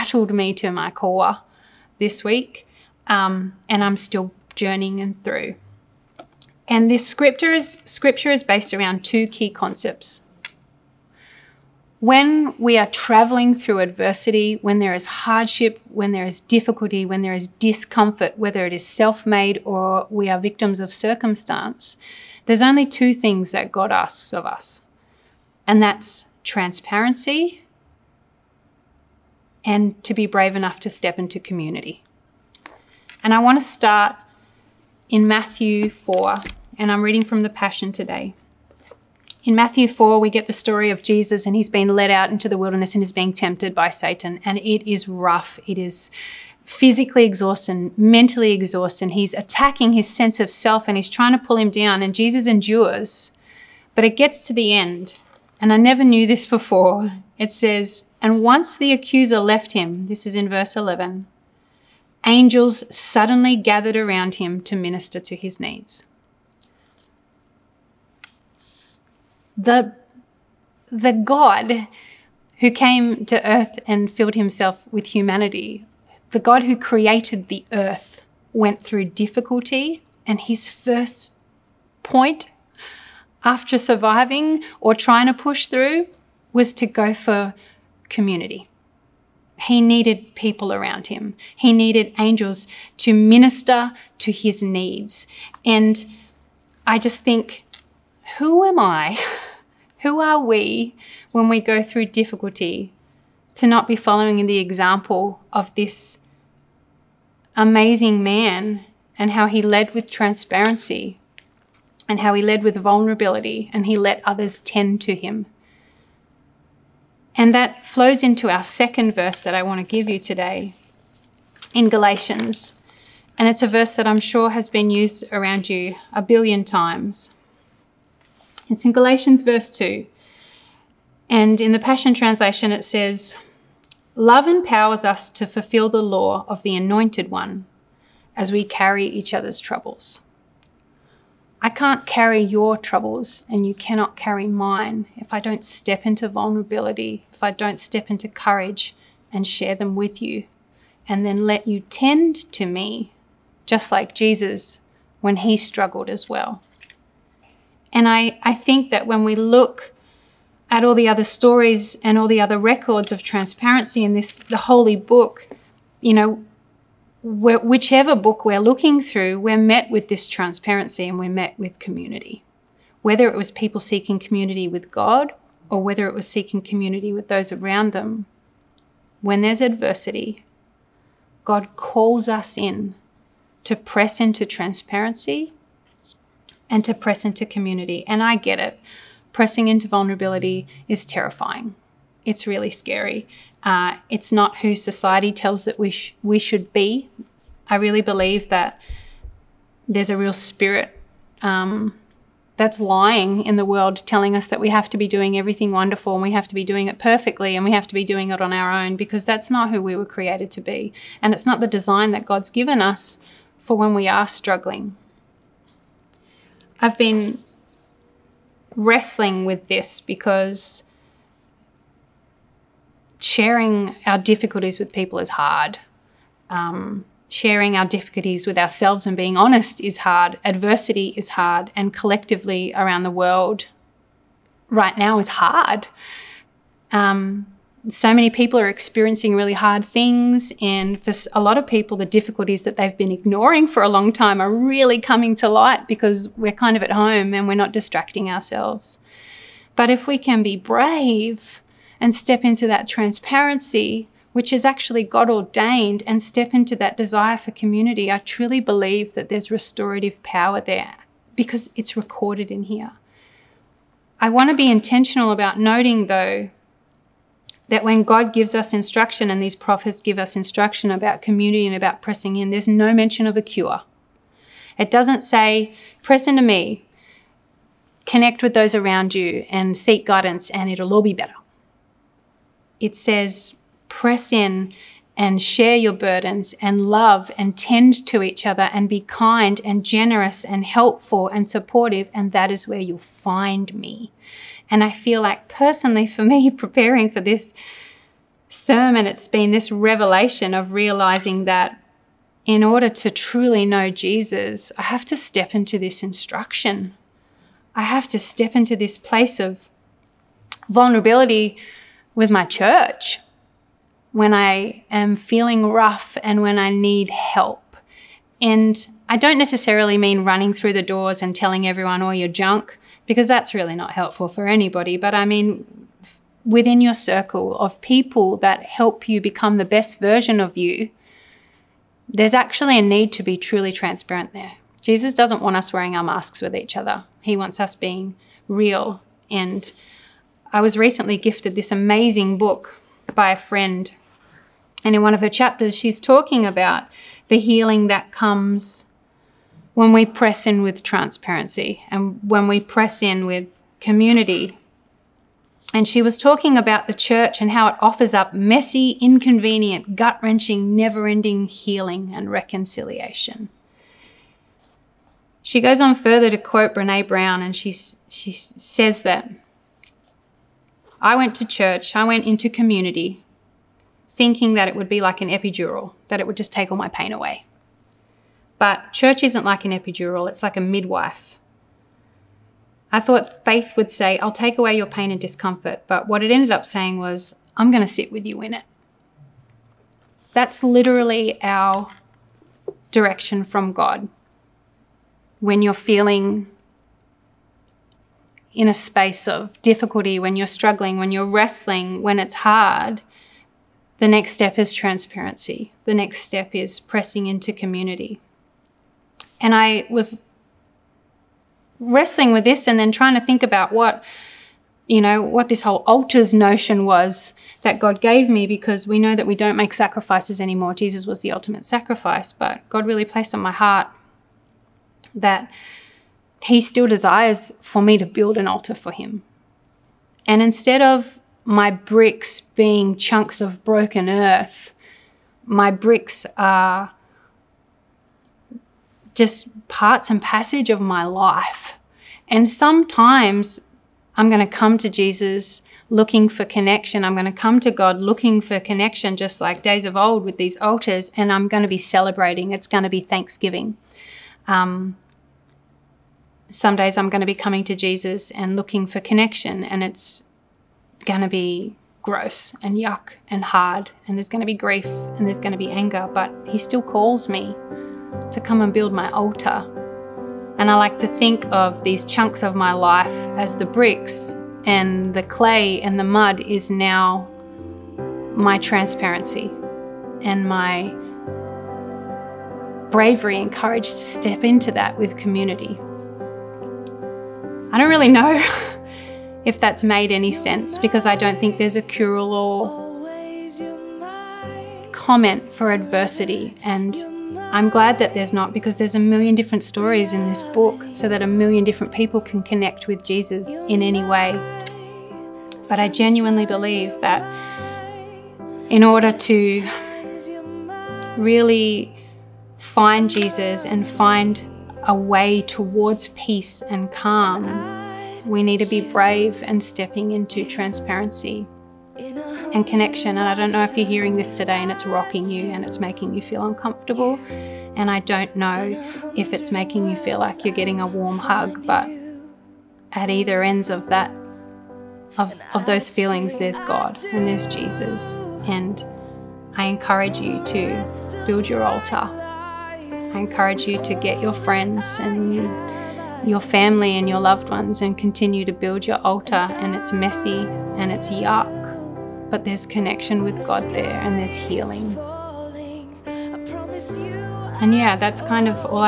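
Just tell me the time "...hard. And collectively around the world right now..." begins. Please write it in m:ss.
3:51.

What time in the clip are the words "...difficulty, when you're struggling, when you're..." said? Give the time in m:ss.
6:39.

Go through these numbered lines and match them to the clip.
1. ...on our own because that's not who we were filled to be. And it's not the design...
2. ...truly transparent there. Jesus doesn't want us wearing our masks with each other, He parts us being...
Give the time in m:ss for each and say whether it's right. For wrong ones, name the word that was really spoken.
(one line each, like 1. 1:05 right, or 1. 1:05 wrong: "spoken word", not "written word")
1. 3:28 wrong: "created", not "filled"
2. 5:33 wrong: "wants", not "parts".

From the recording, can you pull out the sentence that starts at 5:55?
And she was talking about the church and how it offers up messy, inconvenient, gut wrenching, never ending healing and reconciliation.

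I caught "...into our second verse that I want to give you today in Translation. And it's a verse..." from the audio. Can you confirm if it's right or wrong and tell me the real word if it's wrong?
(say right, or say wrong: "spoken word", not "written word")
wrong: "Galatians", not "Translation".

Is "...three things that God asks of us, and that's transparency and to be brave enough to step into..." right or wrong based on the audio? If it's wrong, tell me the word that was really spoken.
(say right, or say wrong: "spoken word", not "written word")
wrong: "two", not "three".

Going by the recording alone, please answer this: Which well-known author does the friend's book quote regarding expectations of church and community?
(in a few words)
Brene Brown.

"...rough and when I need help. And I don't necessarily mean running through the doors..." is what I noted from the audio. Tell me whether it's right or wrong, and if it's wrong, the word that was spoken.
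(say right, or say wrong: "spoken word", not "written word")
right.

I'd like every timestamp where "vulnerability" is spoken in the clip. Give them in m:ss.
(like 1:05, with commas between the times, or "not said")
1:52, 2:26, 3:09, 5:10.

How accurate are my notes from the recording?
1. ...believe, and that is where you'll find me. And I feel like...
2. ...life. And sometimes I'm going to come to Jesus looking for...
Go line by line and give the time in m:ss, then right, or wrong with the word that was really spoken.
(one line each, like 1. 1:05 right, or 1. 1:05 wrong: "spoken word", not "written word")
1. 4:51 wrong: "supportive", not "believe"
2. 7:21 right.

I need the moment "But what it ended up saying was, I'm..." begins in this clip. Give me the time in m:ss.
6:25.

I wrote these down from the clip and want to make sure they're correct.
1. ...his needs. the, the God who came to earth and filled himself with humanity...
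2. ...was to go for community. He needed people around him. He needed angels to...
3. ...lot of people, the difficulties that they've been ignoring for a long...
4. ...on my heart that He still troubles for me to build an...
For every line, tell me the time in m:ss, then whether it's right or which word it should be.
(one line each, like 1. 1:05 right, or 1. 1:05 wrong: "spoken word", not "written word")
1. 1:05 right
2. 1:26 right
3. 4:01 right
4. 7:03 wrong: "desires", not "troubles".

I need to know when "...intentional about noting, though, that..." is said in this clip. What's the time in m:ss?
4:24.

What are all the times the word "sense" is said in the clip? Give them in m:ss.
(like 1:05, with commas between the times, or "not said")
0:50, 8:10.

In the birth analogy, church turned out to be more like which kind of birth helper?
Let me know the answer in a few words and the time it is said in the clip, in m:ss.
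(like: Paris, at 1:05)
A midwife, at 6:20.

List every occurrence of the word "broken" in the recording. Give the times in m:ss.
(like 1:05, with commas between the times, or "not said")
7:13.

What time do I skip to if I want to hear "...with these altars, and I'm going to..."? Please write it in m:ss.
7:30.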